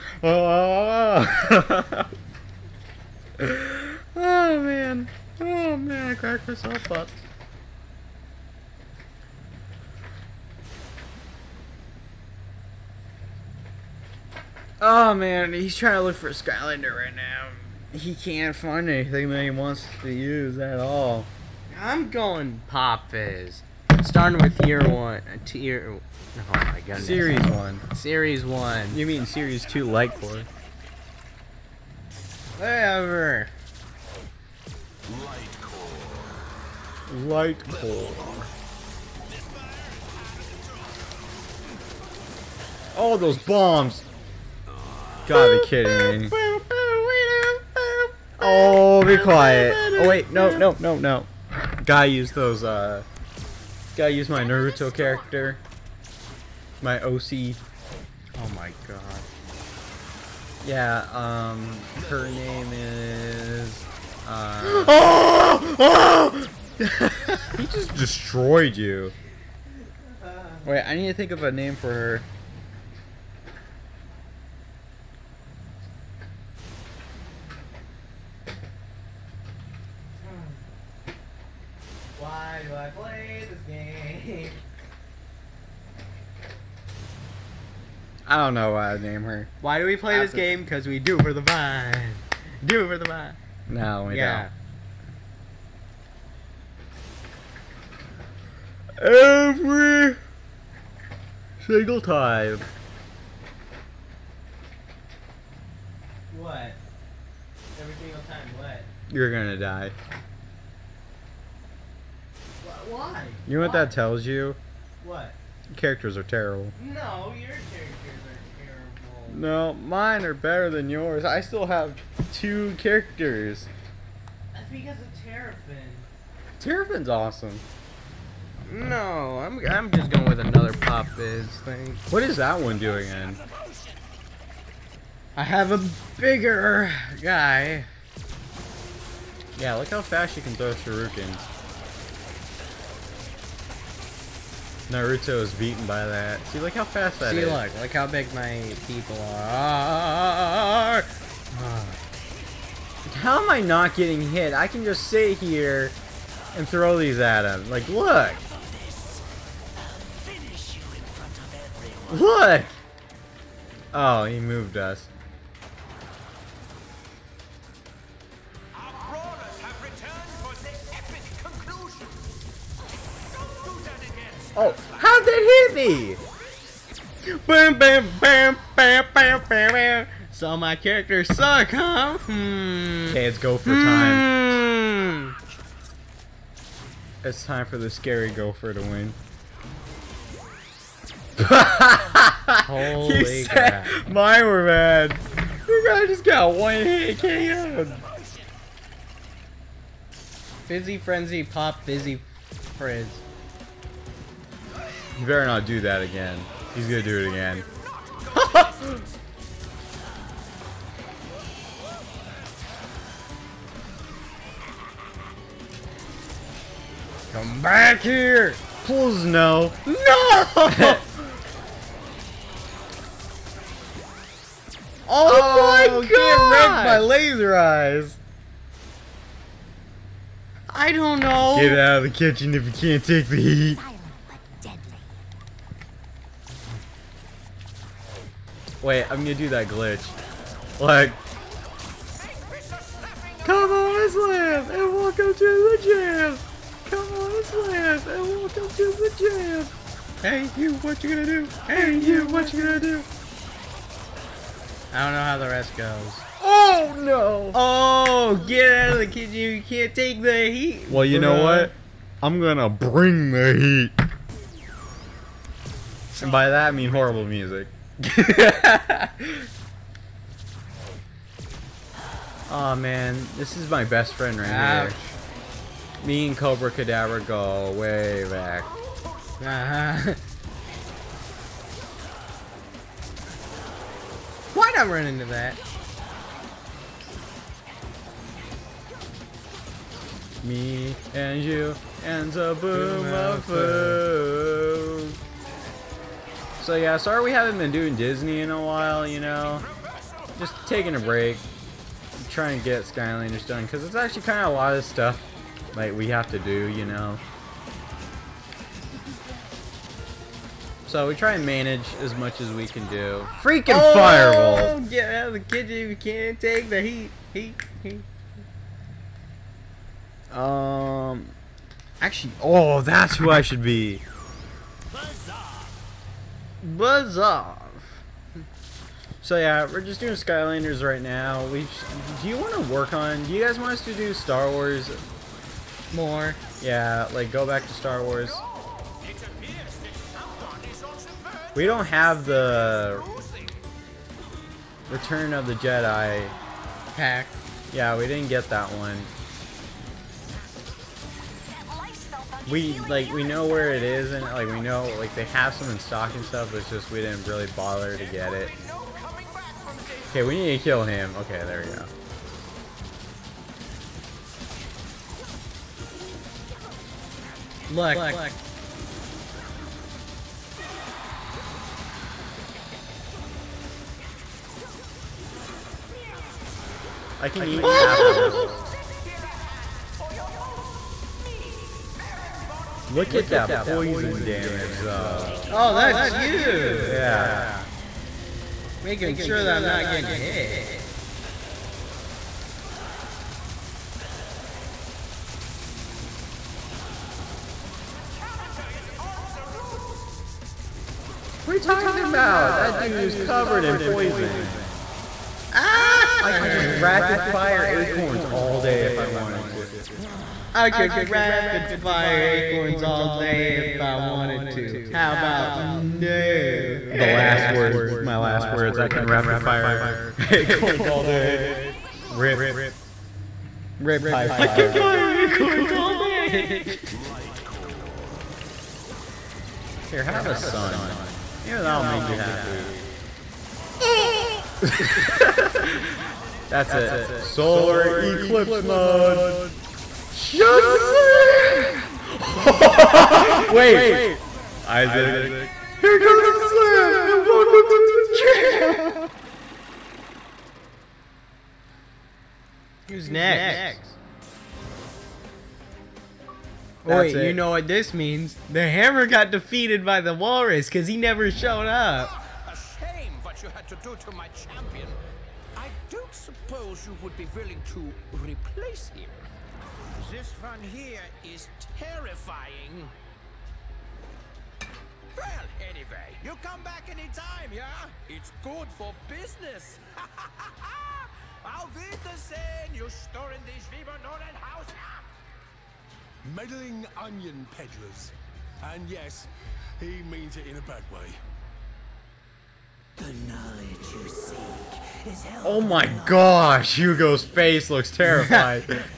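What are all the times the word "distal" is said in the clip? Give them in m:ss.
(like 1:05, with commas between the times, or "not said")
not said.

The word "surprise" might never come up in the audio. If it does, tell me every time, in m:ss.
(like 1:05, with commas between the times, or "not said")
not said.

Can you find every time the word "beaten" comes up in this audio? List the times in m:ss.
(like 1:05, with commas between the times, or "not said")
2:25.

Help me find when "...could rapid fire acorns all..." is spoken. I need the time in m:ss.
6:50.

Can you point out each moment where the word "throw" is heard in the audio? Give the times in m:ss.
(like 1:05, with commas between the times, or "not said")
2:20, 2:36.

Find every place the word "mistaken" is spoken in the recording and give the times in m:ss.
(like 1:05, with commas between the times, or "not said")
not said.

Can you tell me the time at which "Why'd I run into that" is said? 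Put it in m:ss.
4:44.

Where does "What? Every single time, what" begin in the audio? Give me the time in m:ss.
1:46.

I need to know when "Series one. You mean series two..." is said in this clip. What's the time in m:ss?
0:27.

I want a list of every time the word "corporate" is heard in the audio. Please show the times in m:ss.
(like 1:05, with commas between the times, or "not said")
not said.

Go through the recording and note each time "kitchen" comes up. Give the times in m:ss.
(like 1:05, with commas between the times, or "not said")
3:52, 4:19, 5:15.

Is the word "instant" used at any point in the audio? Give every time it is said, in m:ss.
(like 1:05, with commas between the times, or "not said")
not said.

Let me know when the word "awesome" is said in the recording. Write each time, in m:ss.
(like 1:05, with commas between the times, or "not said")
2:07.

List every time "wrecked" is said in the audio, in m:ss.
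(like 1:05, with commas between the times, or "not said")
3:46.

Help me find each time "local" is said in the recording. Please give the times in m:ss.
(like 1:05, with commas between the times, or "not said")
not said.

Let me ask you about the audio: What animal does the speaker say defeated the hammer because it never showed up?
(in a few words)
walrus.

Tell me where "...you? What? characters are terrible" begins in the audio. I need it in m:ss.
1:54.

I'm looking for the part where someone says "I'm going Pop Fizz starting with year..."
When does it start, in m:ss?
0:21.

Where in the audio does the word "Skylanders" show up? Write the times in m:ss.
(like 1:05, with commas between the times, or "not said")
0:16, 5:02, 5:30.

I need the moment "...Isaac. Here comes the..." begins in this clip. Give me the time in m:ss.
7:24.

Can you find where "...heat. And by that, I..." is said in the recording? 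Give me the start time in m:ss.
4:23.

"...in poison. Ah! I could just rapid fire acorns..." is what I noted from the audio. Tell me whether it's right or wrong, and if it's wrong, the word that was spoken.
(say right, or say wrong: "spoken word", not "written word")
right.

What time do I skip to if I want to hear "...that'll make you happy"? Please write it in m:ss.
7:11.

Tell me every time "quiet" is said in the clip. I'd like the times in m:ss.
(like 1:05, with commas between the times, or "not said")
0:49.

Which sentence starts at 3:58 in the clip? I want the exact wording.
Wait, I'm gonna do that glitch.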